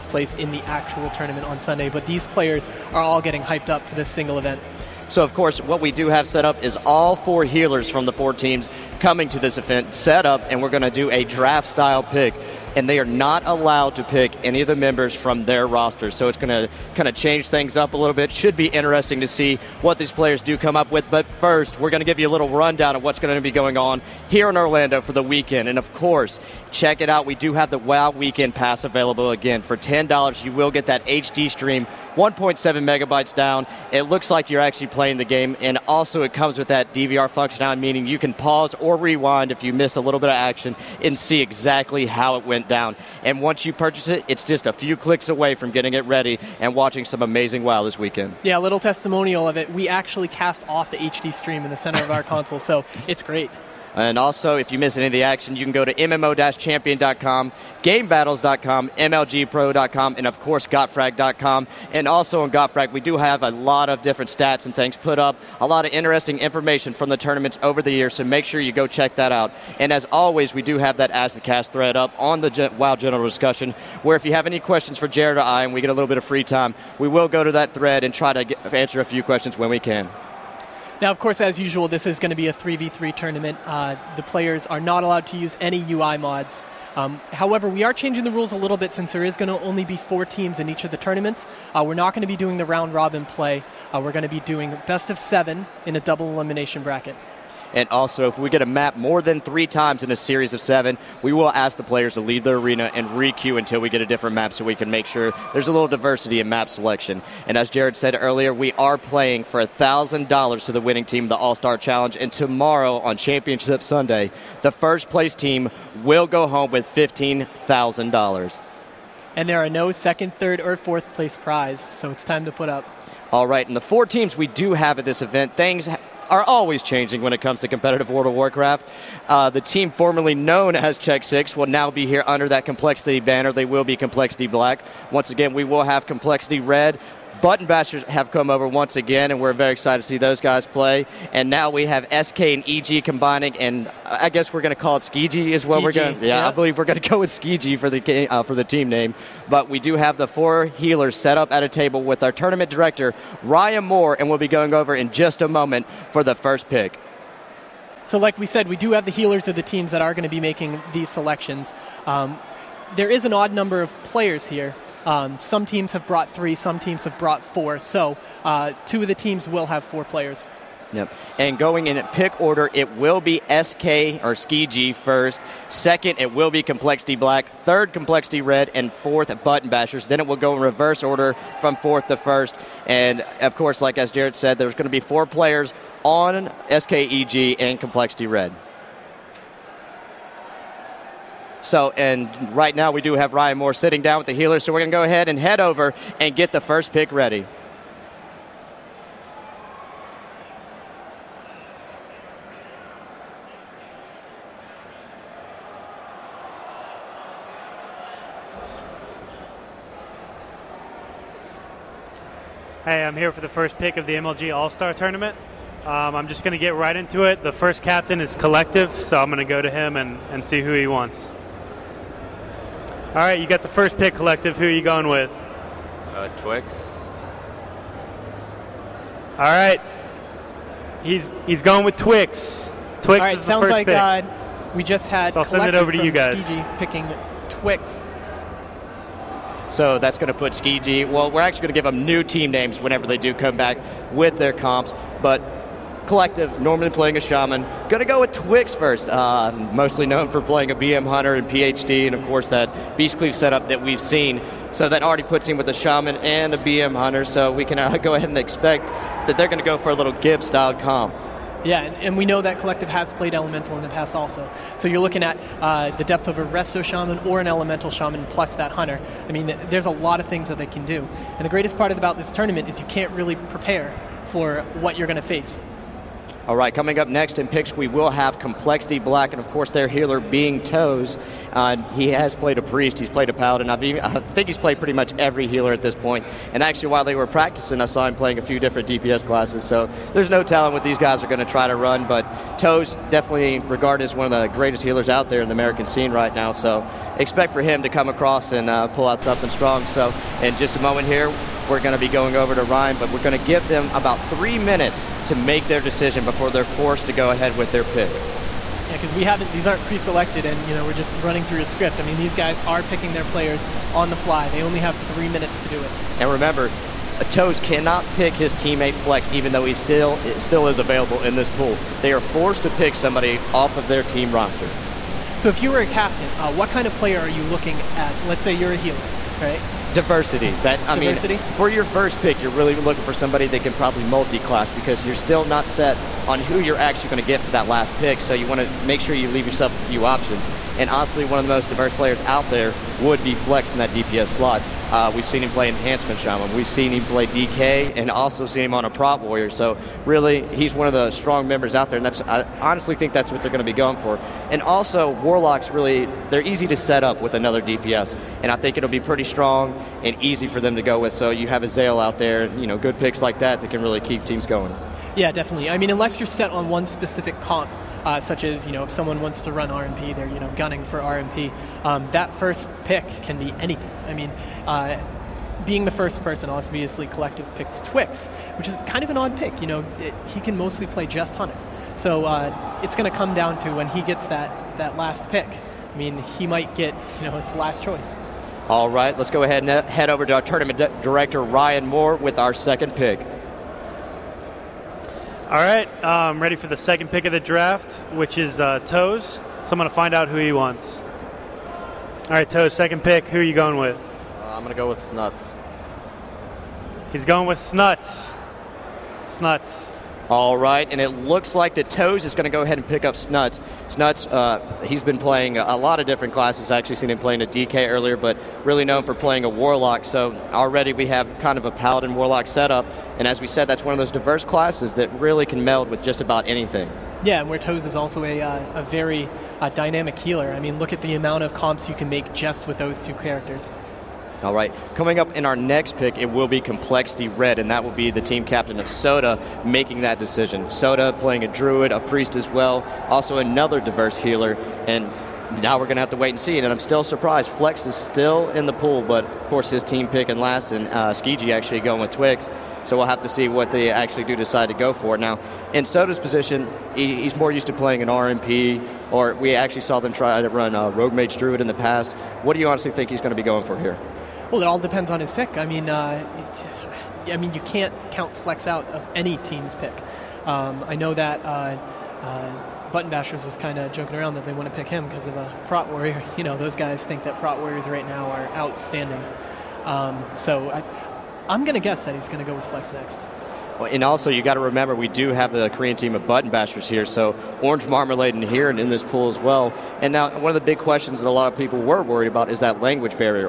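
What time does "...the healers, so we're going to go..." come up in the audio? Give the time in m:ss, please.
3:14.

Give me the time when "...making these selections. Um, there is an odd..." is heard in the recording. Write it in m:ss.
2:40.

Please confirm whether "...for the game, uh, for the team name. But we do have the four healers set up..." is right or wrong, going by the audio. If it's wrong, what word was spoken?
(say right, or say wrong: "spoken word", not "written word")
right.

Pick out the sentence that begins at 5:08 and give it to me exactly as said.
Yeah, because we haven't; these aren't pre-selected, and you know we're just running through a script.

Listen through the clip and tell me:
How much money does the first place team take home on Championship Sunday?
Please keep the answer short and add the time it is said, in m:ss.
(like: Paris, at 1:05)
$15,000, at 1:56.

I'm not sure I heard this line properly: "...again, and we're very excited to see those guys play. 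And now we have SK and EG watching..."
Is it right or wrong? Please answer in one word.
wrong.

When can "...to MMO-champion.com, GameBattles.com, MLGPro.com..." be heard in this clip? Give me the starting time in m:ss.
0:55.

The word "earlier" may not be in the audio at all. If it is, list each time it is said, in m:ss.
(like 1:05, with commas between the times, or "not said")
1:48, 6:57.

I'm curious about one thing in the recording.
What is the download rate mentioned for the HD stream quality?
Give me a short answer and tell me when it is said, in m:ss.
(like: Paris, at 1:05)
1.7 megabytes, at 0:32.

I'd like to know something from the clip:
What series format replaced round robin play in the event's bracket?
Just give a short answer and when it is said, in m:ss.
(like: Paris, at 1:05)
Best of seven, at 1:34.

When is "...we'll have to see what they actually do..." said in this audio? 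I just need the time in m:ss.
7:32.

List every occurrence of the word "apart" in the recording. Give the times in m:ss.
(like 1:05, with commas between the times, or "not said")
not said.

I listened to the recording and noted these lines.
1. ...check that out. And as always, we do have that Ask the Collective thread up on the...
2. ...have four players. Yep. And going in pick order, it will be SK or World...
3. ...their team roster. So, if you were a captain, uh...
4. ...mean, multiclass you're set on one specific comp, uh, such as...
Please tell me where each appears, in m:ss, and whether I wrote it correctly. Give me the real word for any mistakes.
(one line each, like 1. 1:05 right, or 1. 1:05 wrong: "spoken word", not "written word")
1. 1:08 wrong: "Cast", not "Collective"
2. 2:49 wrong: "Ski", not "World"
3. 5:23 right
4. 6:05 wrong: "unless", not "multiclass".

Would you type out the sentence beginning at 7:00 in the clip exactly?
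So already we have kind of a Paladin Warlock setup.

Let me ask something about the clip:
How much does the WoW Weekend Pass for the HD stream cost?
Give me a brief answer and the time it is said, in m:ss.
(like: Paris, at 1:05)
$10, at 0:29.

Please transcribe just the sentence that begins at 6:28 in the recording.
All right, let's go ahead and head over to our tournament director, Ryan Moore, with our second pick.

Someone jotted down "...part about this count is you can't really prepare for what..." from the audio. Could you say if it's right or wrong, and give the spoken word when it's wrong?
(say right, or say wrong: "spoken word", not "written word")
wrong: "tournament", not "count".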